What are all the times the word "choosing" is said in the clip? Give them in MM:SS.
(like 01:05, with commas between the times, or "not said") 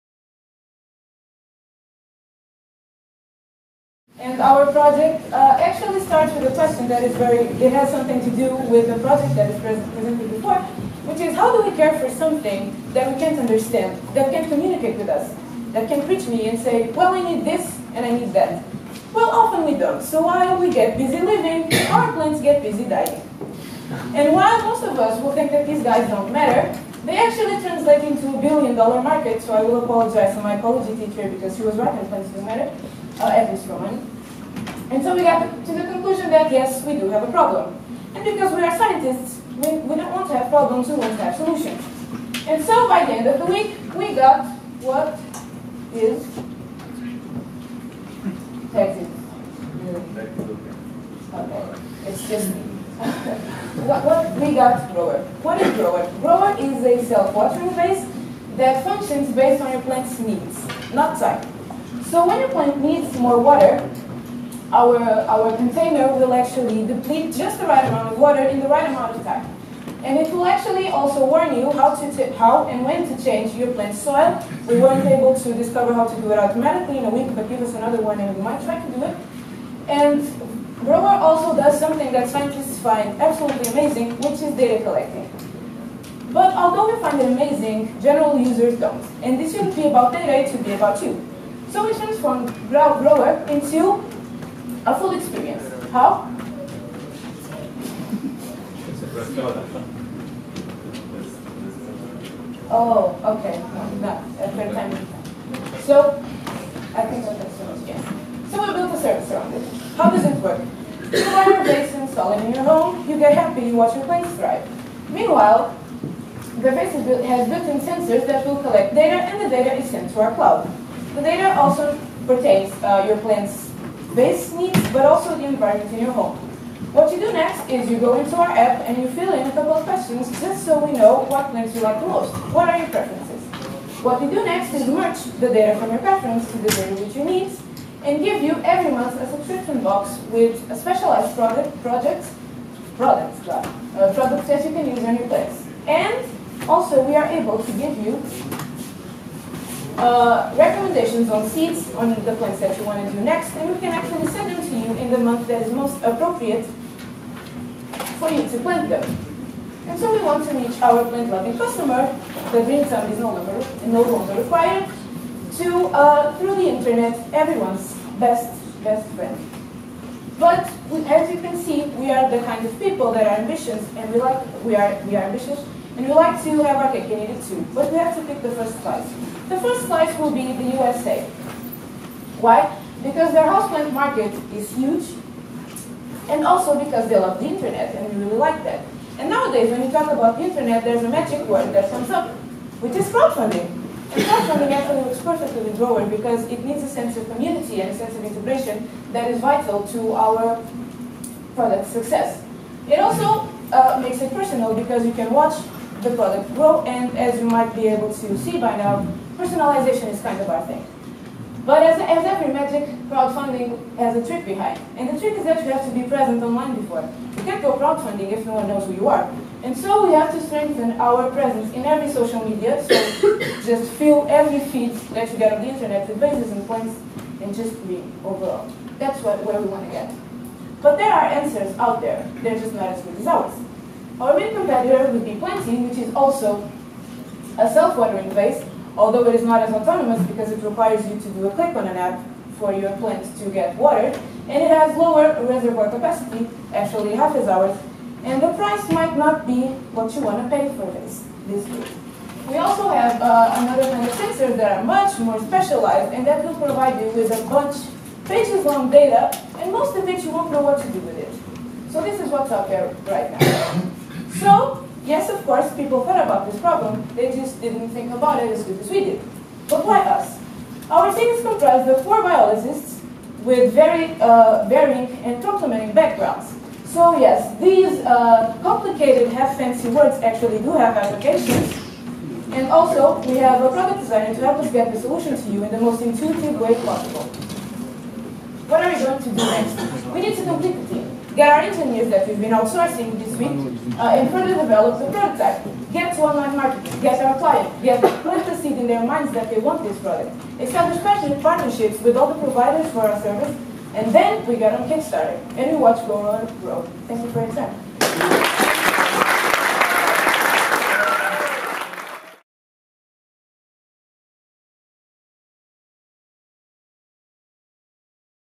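not said.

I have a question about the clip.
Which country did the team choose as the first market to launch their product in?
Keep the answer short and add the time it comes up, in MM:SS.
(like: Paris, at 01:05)
USA, at 03:00.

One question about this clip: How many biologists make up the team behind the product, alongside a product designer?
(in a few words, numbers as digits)
4.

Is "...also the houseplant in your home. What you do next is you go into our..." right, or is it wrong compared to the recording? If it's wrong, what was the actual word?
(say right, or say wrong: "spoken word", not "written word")
wrong: "environment", not "houseplant".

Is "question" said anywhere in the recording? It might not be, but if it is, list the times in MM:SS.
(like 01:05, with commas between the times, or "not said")
00:06, 02:09.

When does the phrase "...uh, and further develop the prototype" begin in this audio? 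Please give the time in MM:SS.
04:53.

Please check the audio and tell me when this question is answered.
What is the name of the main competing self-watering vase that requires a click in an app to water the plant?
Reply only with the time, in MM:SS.
03:55.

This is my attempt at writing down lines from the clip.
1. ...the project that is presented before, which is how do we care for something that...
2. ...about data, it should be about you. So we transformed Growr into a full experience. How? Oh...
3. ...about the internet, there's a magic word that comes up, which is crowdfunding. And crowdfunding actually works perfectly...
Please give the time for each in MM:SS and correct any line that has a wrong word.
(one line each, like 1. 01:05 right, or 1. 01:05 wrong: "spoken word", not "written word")
1. 00:08 right
2. 01:29 right
3. 03:10 right.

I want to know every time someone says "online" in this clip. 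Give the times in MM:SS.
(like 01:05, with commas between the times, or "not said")
03:36, 04:56.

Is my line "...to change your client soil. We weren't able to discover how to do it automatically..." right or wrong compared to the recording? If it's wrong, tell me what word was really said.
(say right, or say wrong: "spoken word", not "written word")
wrong: "plant", not "client".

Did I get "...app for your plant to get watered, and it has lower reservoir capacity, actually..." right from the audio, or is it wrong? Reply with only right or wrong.
right.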